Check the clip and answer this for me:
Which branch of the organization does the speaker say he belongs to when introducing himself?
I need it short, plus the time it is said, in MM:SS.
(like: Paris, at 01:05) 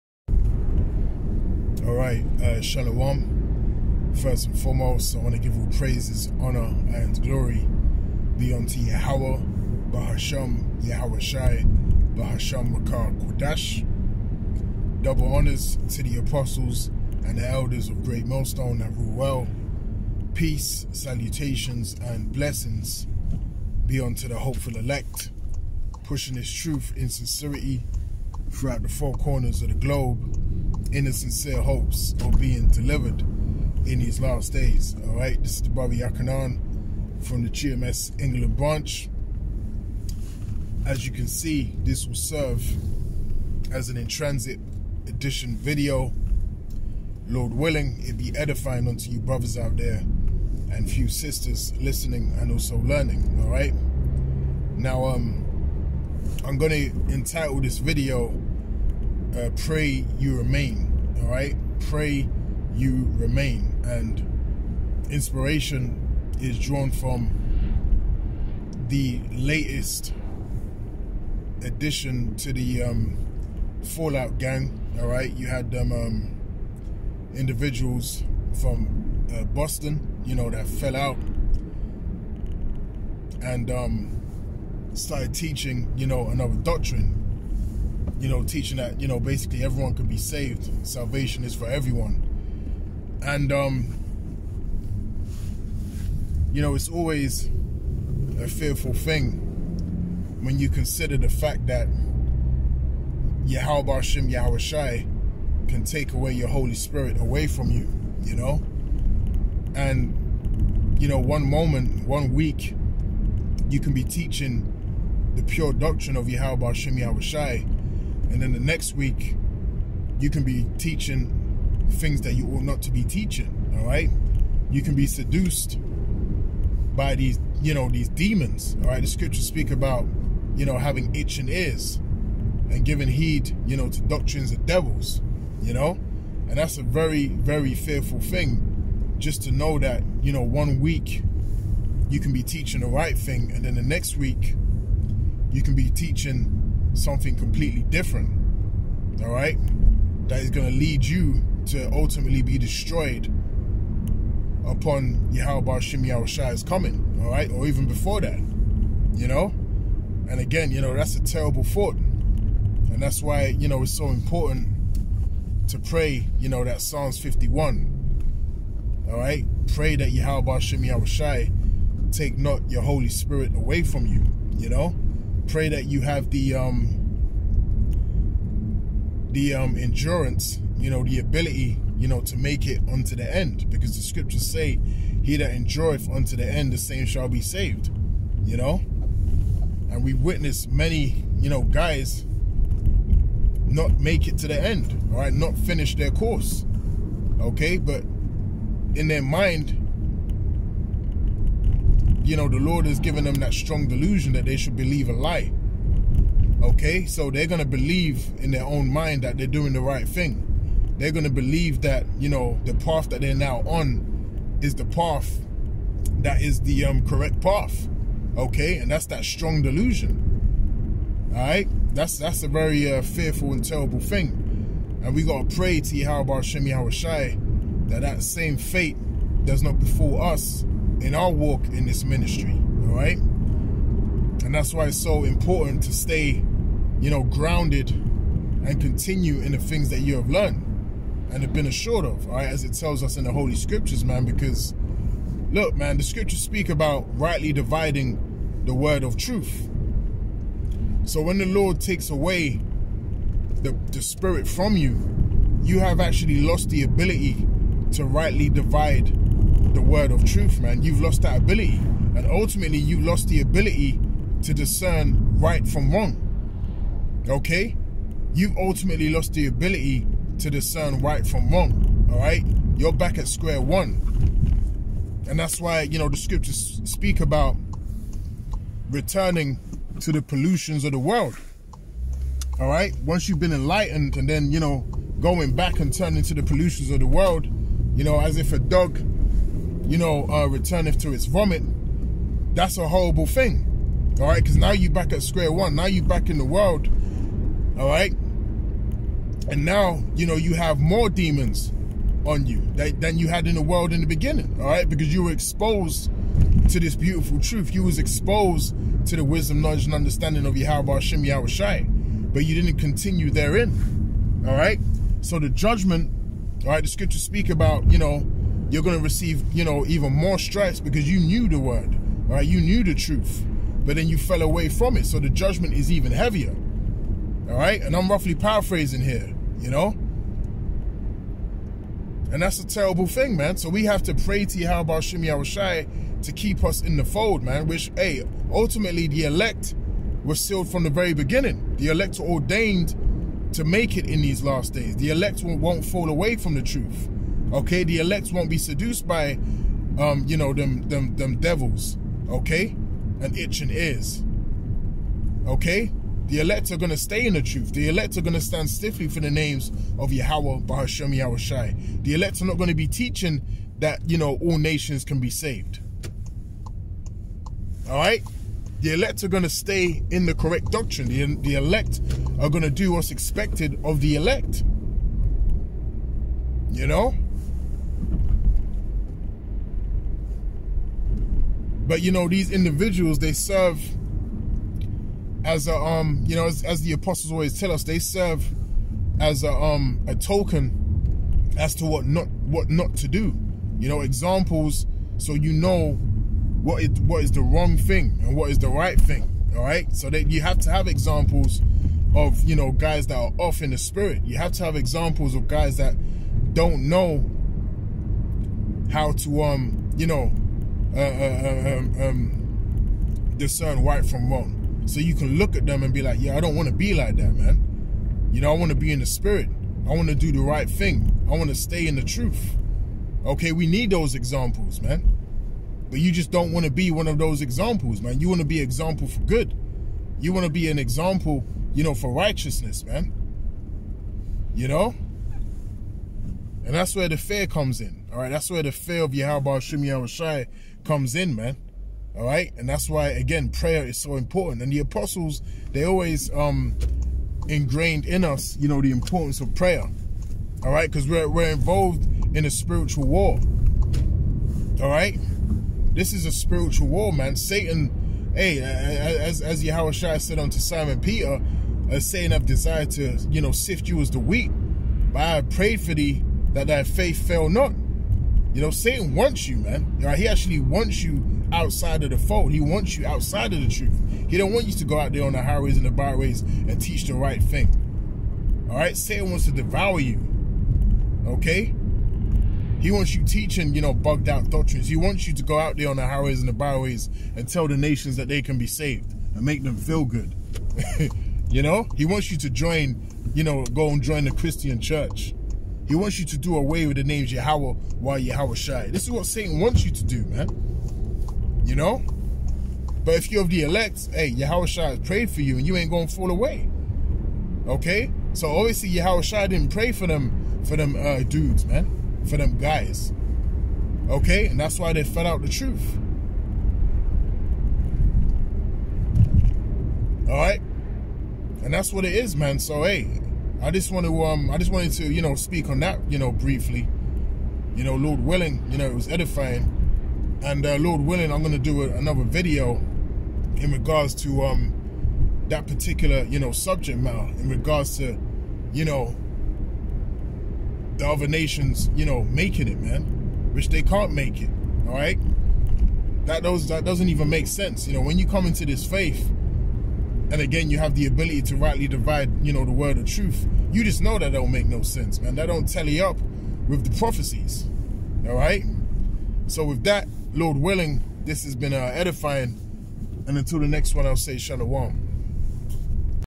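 GMS England, at 00:37.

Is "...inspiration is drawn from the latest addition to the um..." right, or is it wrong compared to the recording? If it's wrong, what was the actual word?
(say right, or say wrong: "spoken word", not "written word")
right.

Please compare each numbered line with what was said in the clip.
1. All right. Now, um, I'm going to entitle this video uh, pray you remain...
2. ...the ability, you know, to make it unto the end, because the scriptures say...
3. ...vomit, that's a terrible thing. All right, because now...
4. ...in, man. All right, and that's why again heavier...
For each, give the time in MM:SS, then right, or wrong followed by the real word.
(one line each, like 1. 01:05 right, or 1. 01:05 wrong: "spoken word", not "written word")
1. 00:53 right
2. 03:01 right
3. 04:51 wrong: "horrible", not "terrible"
4. 07:21 wrong: "prayer", not "heavier".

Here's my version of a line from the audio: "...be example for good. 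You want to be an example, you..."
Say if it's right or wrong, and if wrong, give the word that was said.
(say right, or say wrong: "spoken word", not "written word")
right.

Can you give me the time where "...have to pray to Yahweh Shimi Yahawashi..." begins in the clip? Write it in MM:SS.
05:33.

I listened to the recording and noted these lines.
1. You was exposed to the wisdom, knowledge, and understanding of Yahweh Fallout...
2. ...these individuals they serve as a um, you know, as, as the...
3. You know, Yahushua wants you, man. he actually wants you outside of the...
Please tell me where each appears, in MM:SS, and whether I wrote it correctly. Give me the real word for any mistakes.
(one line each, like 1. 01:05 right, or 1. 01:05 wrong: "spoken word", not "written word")
1. 05:07 wrong: "Hashem", not "Fallout"
2. 06:22 right
3. 07:48 wrong: "Satan", not "Yahushua".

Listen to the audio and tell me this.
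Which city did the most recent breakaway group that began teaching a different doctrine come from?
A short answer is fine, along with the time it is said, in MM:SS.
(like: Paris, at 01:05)
Boston, at 01:19.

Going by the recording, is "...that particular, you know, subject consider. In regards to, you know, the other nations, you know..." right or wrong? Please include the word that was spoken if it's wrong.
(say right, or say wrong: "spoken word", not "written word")
wrong: "matter", not "consider".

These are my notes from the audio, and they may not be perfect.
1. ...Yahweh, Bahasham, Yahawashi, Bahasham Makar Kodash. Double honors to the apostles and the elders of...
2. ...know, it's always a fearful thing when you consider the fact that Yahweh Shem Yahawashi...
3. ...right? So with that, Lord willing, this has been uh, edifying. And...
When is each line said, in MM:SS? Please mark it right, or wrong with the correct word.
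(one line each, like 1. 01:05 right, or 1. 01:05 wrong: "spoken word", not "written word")
1. 00:08 right
2. 01:36 right
3. 09:18 right.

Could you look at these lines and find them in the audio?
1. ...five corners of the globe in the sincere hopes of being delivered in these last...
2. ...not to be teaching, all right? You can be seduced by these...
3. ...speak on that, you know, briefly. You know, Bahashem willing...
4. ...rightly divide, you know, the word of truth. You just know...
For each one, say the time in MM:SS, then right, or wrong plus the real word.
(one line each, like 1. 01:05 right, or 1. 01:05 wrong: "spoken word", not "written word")
1. 00:28 wrong: "four", not "five"
2. 02:02 right
3. 08:45 wrong: "Lord", not "Bahashem"
4. 09:11 right.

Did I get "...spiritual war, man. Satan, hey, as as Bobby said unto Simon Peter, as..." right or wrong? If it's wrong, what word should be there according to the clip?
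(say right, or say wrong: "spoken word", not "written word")
wrong: "Yahweh", not "Bobby".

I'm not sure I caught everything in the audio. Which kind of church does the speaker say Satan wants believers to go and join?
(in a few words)
Christian church.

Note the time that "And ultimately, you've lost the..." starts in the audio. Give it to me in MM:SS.
04:22.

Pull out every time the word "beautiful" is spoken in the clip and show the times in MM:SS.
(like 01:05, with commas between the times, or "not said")
05:06.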